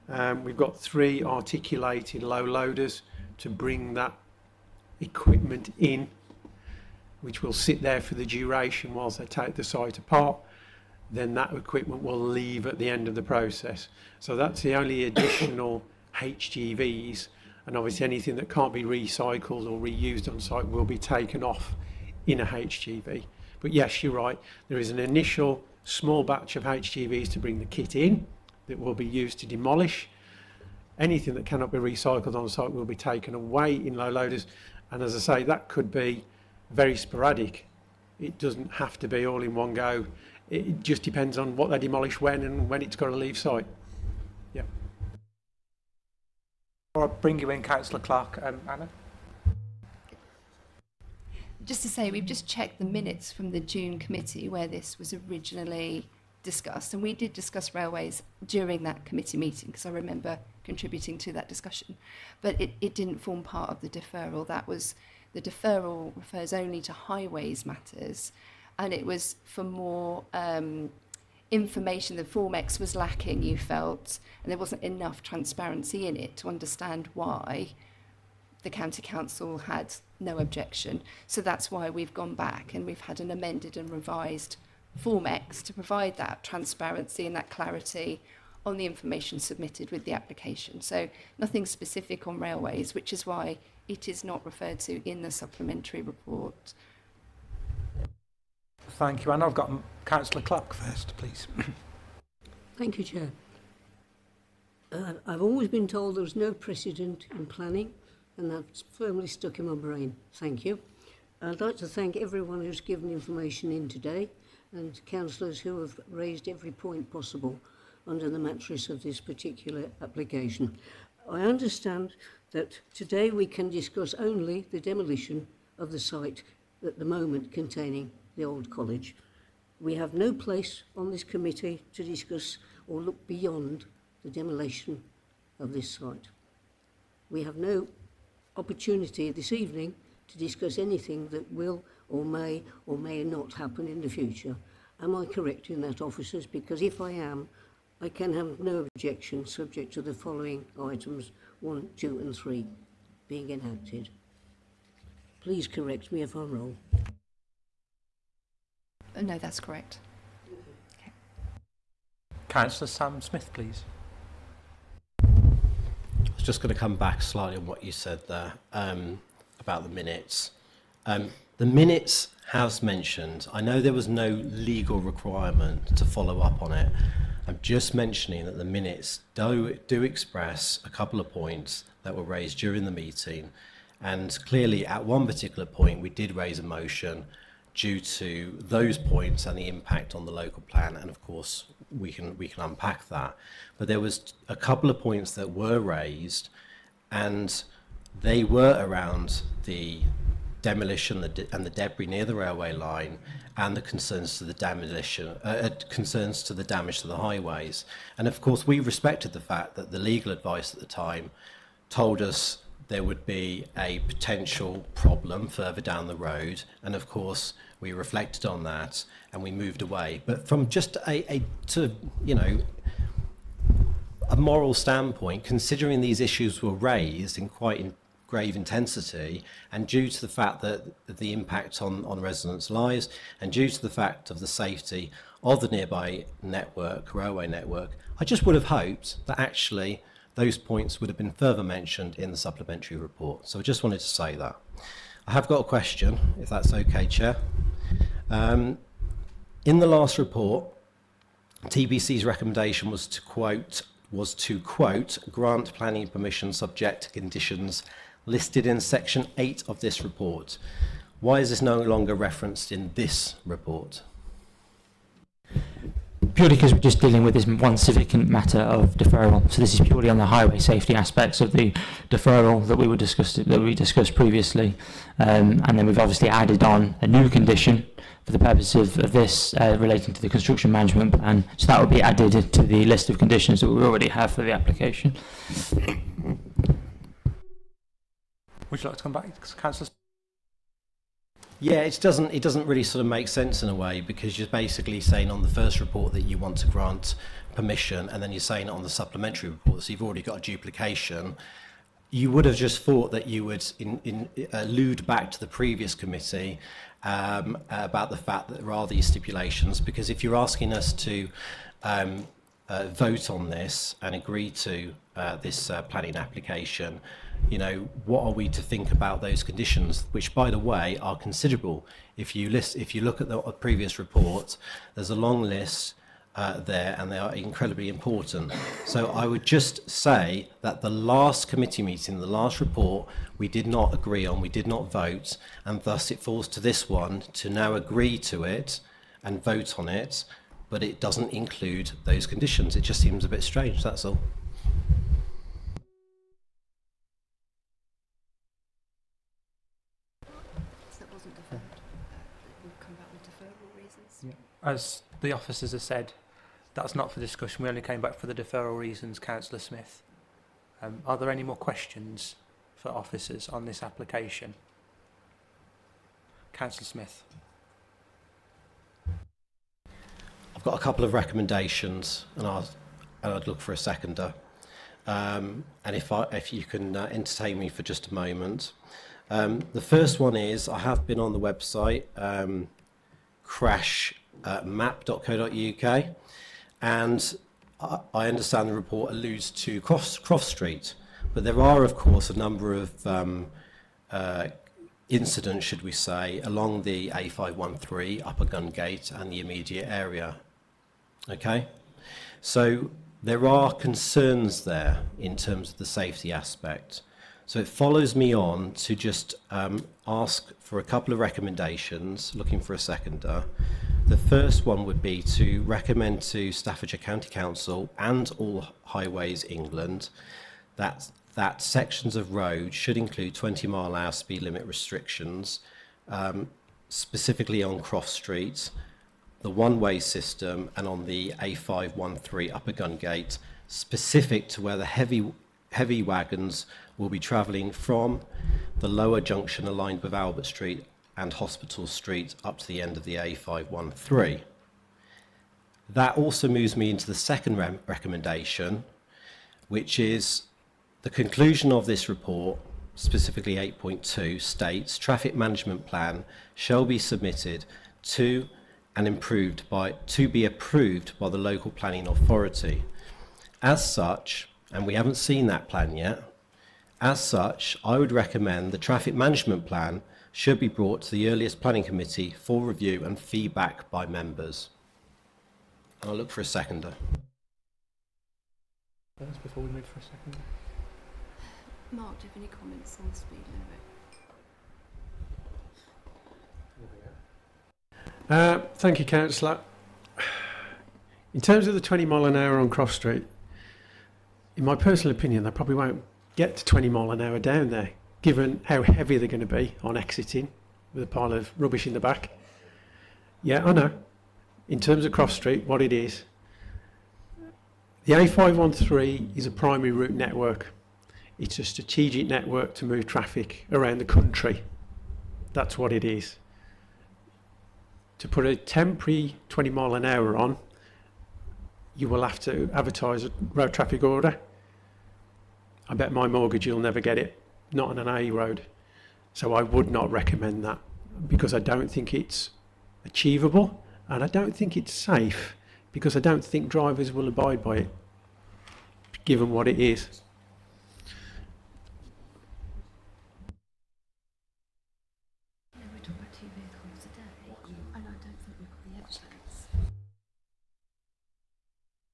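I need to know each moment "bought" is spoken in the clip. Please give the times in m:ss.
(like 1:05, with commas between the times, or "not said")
not said.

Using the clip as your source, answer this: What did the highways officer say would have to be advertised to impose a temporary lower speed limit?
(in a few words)
road traffic order.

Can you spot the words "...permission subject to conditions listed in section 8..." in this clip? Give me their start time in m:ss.
4:16.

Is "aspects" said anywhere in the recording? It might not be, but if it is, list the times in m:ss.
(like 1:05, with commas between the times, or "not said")
4:30, 6:46.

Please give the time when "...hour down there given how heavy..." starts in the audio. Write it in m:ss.
8:17.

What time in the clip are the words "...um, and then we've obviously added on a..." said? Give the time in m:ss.
4:35.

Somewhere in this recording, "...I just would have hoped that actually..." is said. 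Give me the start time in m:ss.
3:58.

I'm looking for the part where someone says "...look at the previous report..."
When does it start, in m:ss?
5:22.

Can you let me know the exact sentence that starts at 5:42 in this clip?
It just seems a bit strange.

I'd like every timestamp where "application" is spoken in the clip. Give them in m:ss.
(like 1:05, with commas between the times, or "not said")
1:30, 2:00, 4:44, 5:16, 6:03.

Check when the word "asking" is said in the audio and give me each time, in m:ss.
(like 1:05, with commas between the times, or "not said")
5:10.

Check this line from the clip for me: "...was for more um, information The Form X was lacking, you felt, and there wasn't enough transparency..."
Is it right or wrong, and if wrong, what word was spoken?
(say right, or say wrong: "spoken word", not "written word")
right.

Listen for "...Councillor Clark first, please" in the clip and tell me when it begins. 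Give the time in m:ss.
1:40.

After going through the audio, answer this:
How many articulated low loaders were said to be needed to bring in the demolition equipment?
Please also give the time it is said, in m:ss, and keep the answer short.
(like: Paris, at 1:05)
3, at 0:00.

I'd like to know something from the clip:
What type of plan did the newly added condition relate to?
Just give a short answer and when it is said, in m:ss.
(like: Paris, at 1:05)
construction management plan, at 4:40.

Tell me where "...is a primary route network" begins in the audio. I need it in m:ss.
8:29.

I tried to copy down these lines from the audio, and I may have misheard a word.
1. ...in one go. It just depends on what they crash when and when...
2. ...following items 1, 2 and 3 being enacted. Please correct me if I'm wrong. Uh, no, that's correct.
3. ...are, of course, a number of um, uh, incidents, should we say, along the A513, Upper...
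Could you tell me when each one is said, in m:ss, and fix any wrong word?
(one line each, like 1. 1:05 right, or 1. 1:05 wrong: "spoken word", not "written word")
1. 0:39 wrong: "demolish", not "crash"
2. 2:30 right
3. 6:31 right.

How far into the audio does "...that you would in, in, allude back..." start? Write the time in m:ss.
5:03.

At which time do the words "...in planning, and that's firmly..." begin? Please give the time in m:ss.
1:47.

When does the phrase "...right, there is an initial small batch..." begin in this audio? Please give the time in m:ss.
0:24.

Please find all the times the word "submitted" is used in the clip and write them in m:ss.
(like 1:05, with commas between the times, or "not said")
1:29, 7:36.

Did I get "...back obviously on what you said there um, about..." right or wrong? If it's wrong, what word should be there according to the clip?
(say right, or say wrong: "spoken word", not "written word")
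wrong: "slightly", not "obviously".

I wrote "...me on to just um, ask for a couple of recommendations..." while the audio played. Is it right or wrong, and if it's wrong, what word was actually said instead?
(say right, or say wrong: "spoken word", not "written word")
right.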